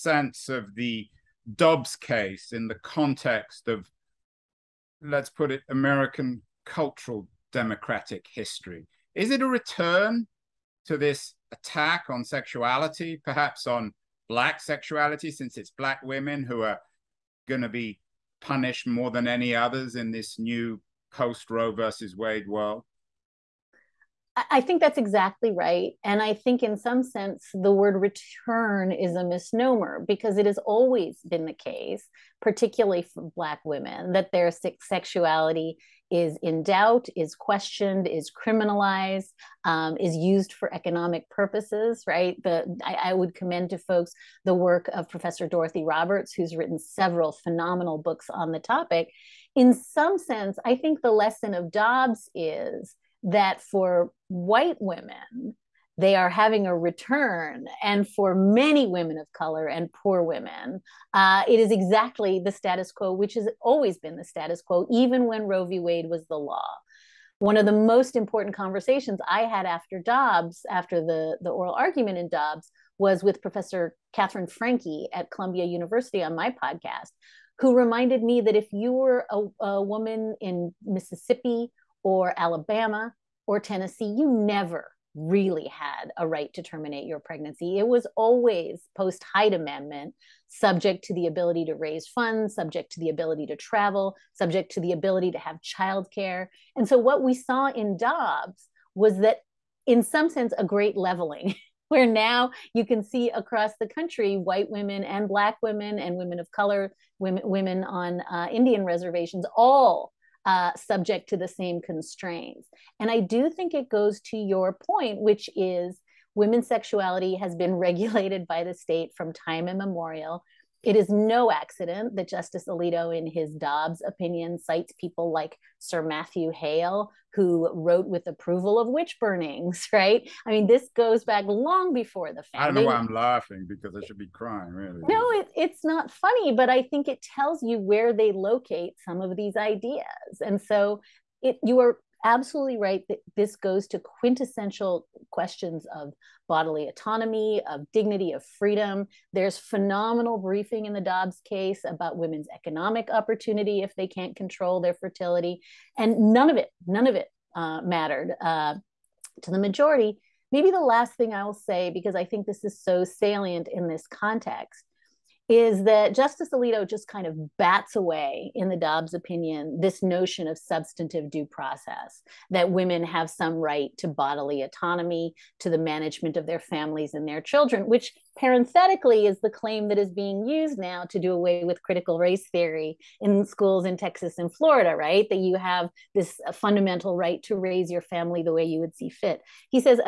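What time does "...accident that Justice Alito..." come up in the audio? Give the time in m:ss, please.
2:01.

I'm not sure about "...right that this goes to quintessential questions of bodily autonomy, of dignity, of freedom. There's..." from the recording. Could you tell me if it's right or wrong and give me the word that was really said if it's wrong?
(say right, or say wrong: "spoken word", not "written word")
right.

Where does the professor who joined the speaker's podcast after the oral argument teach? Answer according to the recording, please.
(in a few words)
Columbia University.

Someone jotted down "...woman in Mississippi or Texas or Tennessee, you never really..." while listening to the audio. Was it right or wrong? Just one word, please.
wrong.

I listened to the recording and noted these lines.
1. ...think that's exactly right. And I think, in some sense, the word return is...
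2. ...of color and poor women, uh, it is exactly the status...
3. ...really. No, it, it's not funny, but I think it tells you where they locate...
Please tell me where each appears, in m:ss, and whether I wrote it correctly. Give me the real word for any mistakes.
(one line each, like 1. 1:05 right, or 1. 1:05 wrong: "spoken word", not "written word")
1. 0:24 right
2. 0:59 right
3. 2:14 right.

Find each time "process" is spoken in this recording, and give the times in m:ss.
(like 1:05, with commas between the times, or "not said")
2:51.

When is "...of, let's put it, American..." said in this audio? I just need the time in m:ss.
0:03.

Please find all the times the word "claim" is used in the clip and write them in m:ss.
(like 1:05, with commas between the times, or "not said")
2:59.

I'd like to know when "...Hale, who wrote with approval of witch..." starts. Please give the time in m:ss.
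2:06.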